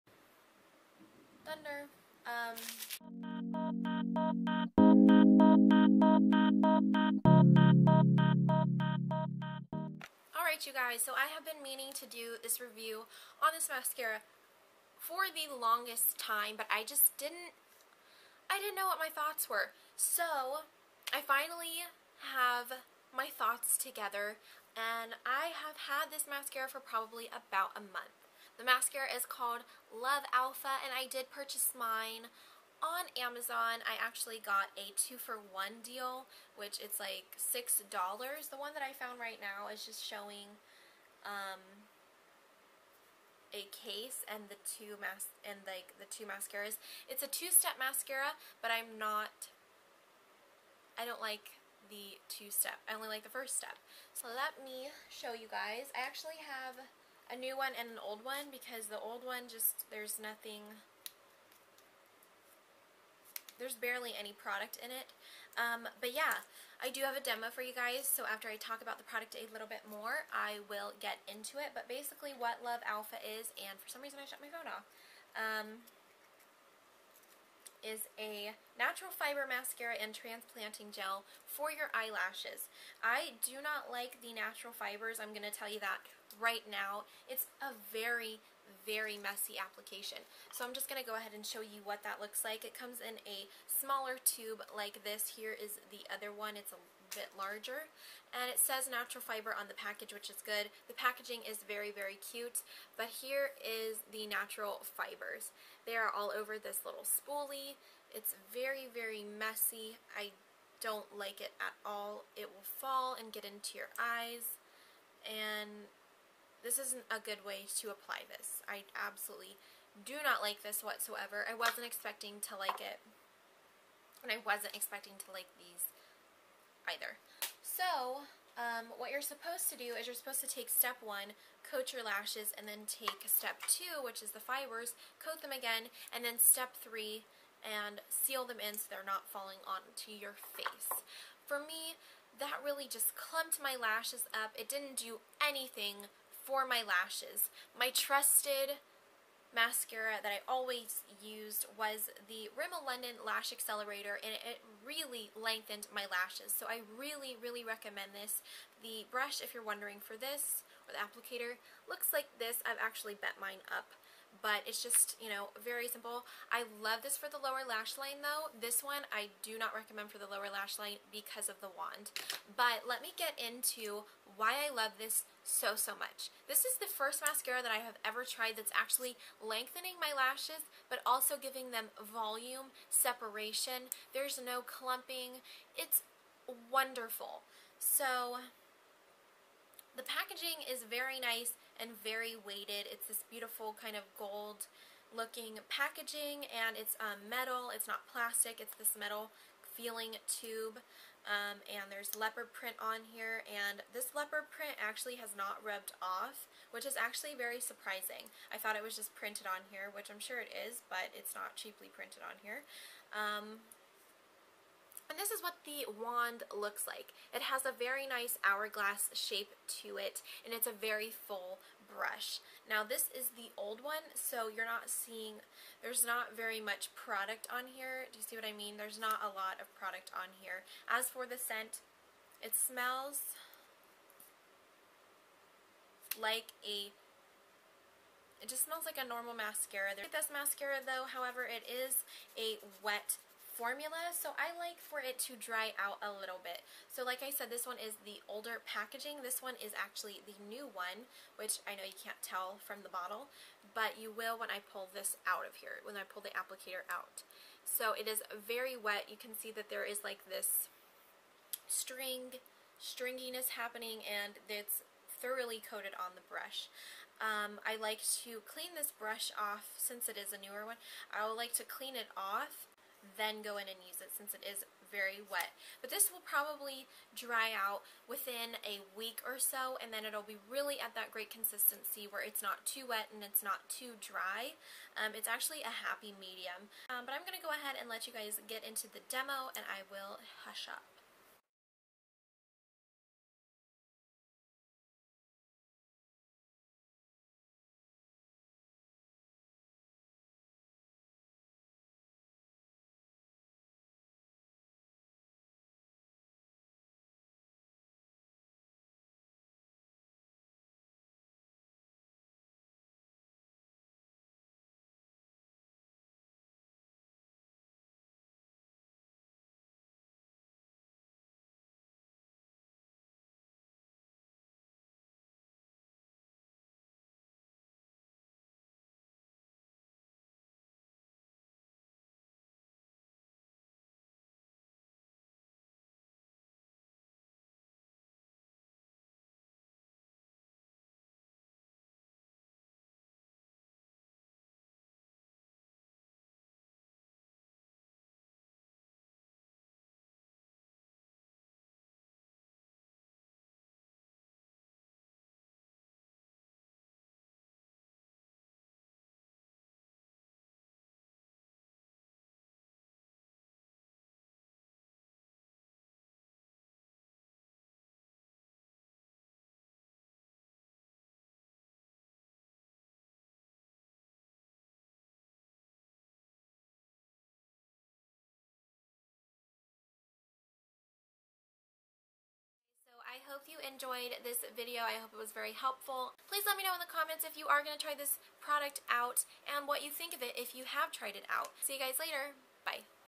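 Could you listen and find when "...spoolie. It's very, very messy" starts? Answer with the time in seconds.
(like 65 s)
107 s.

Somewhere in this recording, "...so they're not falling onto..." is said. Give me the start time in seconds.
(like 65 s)
138 s.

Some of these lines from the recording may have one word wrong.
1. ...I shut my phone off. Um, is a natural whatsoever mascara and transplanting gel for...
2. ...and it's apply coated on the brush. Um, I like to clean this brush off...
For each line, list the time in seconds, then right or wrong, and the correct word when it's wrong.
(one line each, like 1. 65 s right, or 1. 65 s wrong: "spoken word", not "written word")
1. 74 s wrong: "fiber", not "whatsoever"
2. 264 s wrong: "thoroughly", not "apply".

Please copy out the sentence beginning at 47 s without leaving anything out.
It's a two-step mascara, but I'm not I don't like the two-step.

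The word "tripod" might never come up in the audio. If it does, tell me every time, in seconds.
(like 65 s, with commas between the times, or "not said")
not said.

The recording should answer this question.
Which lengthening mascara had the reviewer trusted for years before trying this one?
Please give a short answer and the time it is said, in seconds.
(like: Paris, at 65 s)
Rimmel London Lash Accelerator, at 152 s.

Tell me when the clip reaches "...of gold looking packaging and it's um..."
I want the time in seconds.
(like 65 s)
193 s.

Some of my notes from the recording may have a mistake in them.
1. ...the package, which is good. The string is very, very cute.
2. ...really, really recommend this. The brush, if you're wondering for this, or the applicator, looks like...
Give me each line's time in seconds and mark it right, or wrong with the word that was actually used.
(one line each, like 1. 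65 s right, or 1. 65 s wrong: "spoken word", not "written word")
1. 99 s wrong: "packaging", not "string"
2. 156 s right.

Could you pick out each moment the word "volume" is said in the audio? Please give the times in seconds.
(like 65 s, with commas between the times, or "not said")
181 s.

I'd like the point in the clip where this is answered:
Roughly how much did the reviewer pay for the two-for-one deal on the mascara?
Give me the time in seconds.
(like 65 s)
37 s.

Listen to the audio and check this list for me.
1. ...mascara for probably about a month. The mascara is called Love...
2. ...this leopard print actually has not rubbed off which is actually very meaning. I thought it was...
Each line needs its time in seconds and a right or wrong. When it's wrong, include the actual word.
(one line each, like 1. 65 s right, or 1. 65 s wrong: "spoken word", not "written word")
1. 26 s right
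2. 203 s wrong: "surprising", not "meaning".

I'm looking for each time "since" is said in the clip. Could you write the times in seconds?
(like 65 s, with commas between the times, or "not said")
269 s, 274 s.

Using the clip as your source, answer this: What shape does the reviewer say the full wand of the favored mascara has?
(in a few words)
Hourglass.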